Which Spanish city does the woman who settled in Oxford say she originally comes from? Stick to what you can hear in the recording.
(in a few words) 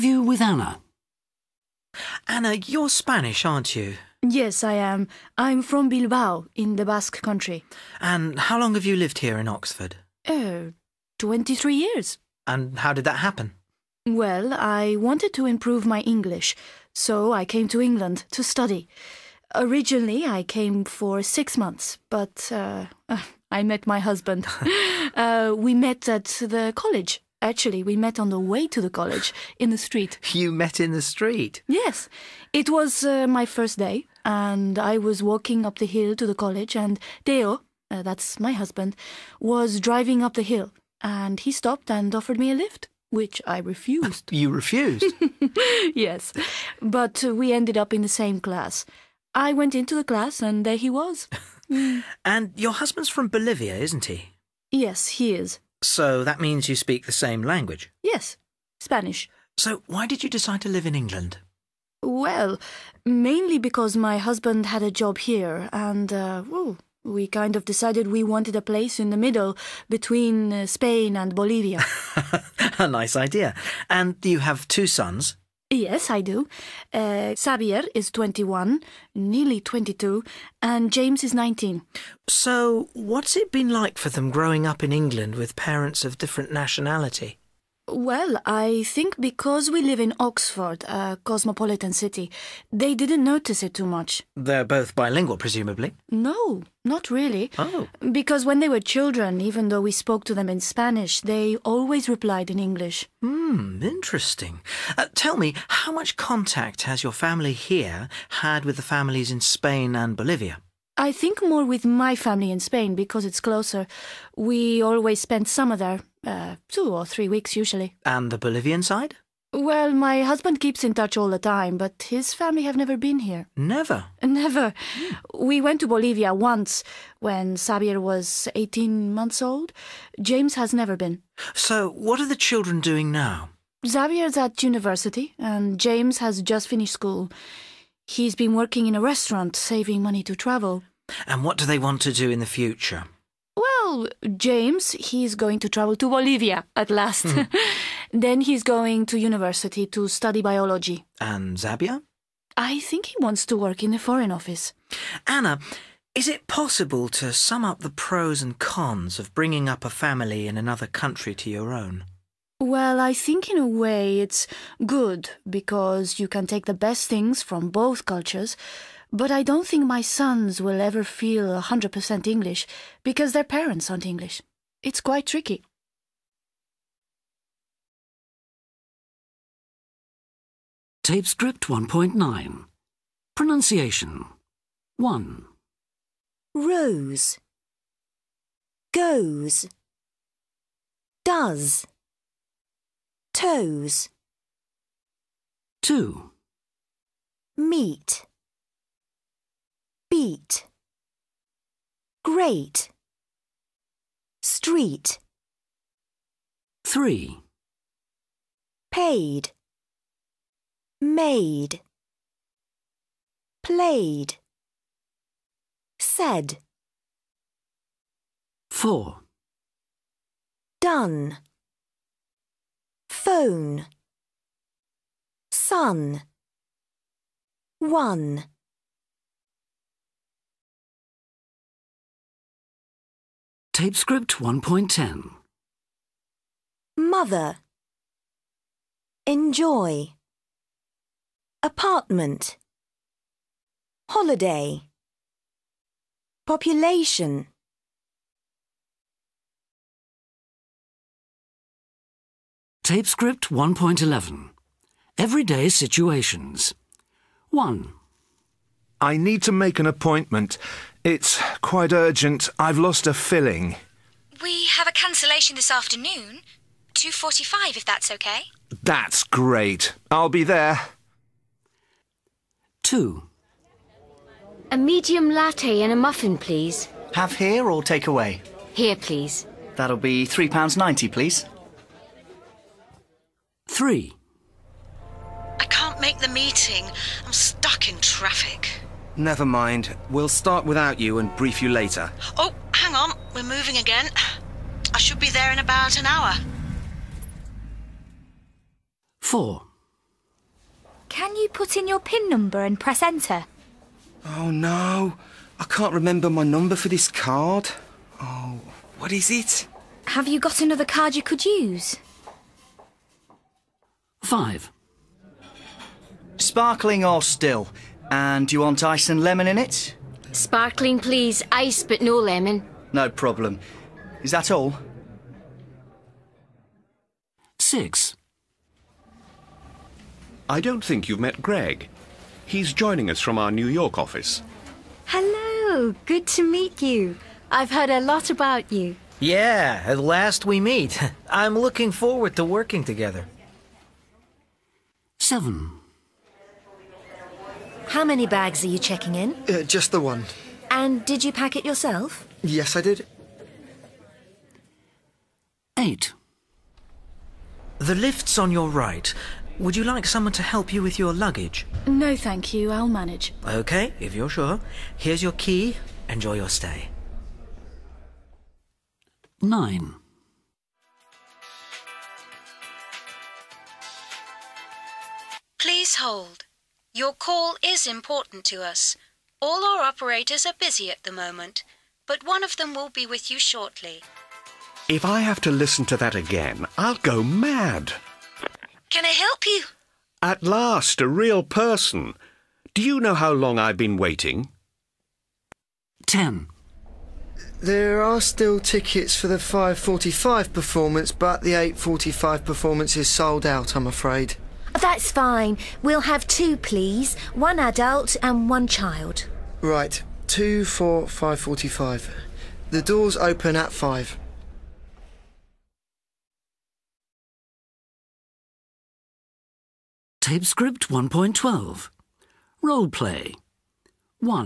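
Bilbao.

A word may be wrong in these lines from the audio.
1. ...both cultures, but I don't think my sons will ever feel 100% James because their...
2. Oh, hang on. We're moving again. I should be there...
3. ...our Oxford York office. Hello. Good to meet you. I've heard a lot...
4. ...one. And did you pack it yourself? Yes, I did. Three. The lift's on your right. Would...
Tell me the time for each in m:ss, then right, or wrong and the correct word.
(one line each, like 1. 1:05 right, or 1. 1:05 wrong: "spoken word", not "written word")
1. 2:47 wrong: "English", not "James"
2. 4:52 right
3. 5:33 wrong: "New", not "Oxford"
4. 5:49 wrong: "Eight", not "Three".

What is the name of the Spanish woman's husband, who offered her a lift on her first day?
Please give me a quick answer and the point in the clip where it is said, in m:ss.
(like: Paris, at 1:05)
Theo, at 0:37.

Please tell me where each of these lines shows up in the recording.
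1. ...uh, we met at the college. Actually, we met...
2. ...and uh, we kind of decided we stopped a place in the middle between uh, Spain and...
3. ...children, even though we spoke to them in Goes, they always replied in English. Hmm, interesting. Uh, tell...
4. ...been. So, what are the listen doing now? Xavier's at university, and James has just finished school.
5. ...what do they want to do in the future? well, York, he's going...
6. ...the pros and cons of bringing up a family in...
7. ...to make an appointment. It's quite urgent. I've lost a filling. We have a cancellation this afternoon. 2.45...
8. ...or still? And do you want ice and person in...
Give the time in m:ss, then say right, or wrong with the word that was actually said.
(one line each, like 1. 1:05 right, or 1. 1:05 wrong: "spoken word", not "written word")
1. 0:25 right
2. 1:05 wrong: "wanted", not "stopped"
3. 1:38 wrong: "Spanish", not "Goes"
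4. 2:10 wrong: "children", not "listen"
5. 2:21 wrong: "James", not "York"
6. 2:37 right
7. 4:19 right
8. 5:17 wrong: "lemon", not "person".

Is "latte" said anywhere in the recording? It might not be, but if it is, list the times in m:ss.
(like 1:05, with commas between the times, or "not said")
4:35.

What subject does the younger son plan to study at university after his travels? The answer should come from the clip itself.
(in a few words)
Biology.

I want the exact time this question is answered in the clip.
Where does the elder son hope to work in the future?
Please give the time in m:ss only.
2:33.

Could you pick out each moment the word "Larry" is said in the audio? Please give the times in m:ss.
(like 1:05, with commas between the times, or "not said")
not said.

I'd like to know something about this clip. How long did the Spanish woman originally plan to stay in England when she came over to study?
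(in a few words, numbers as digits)
6 months.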